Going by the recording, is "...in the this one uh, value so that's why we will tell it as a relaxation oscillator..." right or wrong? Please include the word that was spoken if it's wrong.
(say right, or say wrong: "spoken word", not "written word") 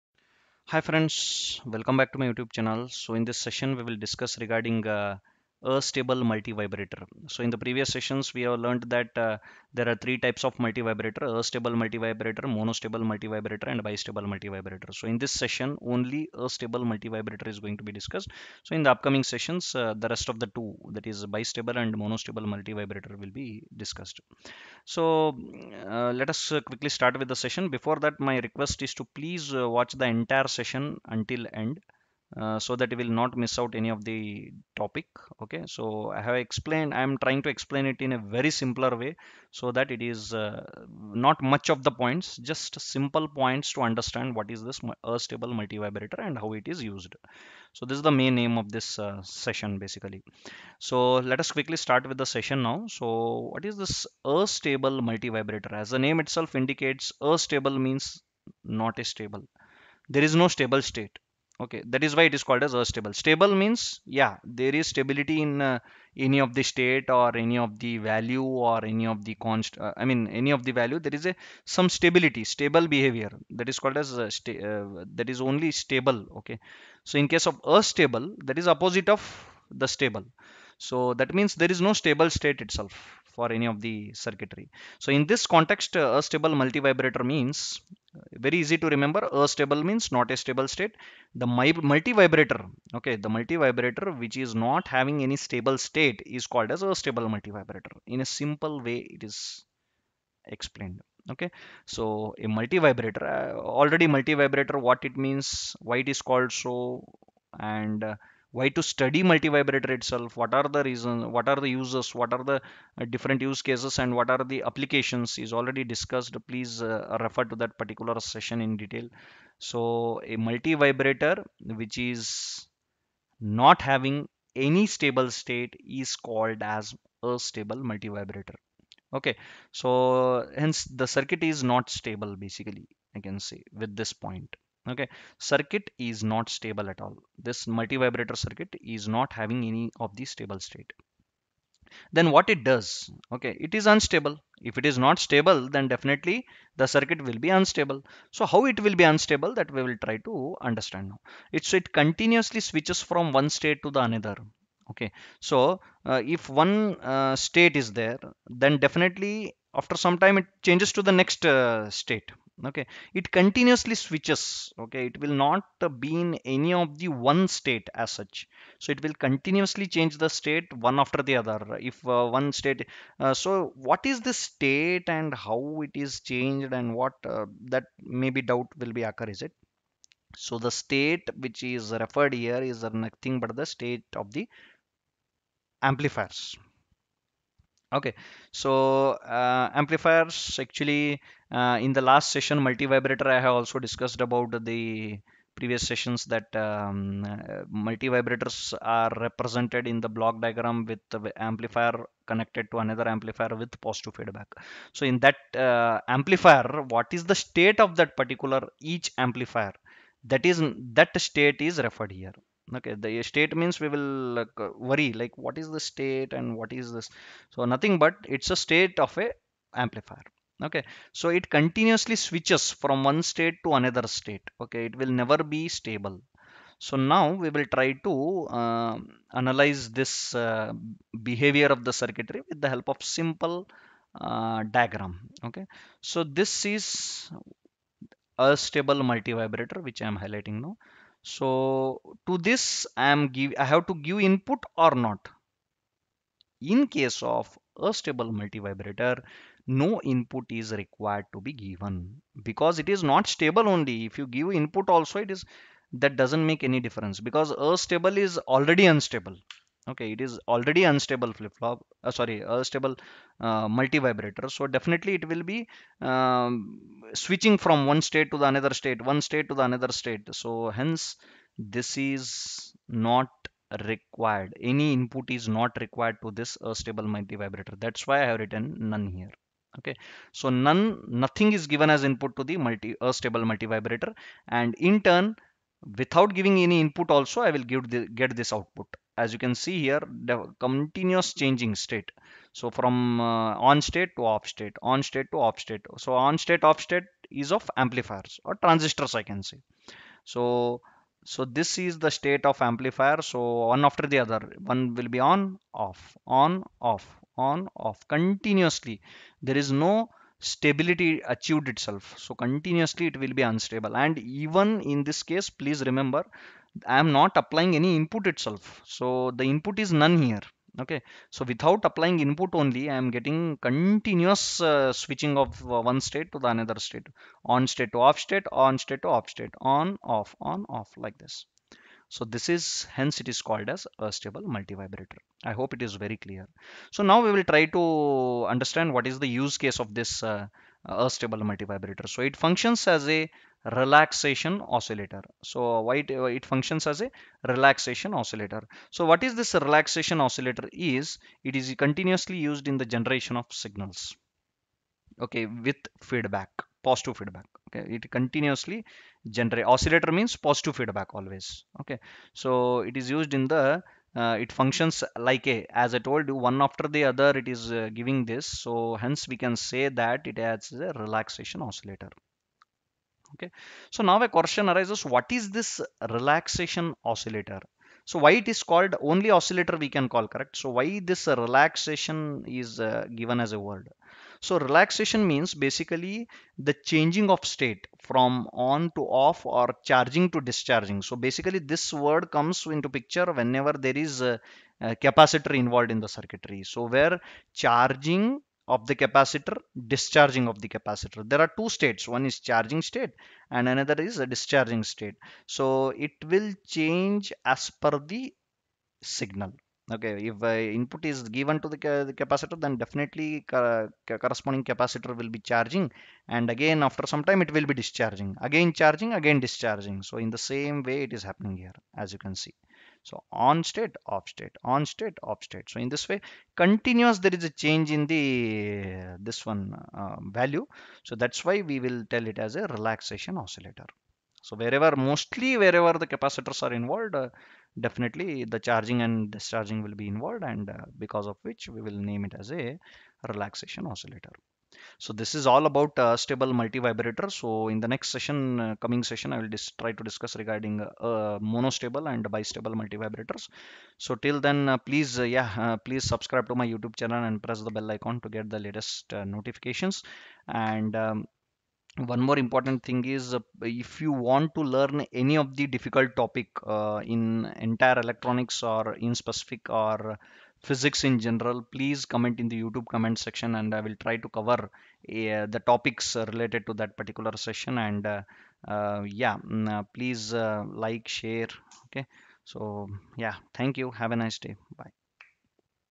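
right.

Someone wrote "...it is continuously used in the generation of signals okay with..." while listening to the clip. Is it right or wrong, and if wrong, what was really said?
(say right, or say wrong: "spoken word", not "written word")
right.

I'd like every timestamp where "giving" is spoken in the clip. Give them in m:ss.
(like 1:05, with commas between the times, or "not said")
4:46, 6:07.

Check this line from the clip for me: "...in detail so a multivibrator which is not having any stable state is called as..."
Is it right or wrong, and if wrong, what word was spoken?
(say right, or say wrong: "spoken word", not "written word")
right.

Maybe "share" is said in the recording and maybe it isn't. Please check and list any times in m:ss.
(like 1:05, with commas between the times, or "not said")
8:01.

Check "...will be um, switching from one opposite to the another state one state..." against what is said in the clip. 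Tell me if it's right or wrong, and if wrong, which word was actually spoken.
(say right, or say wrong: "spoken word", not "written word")
wrong: "state", not "opposite".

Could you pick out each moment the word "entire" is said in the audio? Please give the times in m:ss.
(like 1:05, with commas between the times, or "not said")
0:30, 7:47.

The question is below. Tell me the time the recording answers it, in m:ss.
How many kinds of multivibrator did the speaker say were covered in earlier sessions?
0:09.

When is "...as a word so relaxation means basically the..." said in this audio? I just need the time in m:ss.
6:23.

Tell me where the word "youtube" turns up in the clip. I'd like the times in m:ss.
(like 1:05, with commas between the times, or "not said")
0:02, 7:36, 7:52.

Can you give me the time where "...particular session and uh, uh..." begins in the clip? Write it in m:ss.
7:56.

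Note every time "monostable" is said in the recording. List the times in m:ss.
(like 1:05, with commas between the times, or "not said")
0:12, 0:21, 7:31.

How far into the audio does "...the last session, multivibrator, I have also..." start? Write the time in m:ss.
3:11.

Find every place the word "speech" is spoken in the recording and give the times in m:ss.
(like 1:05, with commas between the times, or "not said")
not said.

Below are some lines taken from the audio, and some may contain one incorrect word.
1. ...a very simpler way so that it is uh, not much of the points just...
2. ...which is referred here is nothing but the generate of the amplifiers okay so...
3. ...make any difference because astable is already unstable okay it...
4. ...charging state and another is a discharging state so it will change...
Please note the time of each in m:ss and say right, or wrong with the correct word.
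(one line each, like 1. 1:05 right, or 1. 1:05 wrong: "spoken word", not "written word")
1. 0:38 right
2. 3:01 wrong: "state", not "generate"
3. 4:16 right
4. 6:42 right.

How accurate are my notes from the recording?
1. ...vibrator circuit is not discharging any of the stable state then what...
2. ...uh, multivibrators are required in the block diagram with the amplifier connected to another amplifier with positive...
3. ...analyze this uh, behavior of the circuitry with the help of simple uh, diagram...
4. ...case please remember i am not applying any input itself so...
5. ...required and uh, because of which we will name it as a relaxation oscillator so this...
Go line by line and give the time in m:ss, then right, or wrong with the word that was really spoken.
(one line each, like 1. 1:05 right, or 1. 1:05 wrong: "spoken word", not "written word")
1. 2:18 wrong: "having", not "discharging"
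2. 3:17 wrong: "represented", not "required"
3. 3:49 right
4. 5:15 right
5. 7:20 wrong: "involved", not "required".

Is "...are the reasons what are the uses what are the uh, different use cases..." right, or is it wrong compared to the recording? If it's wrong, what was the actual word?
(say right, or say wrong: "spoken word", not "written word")
right.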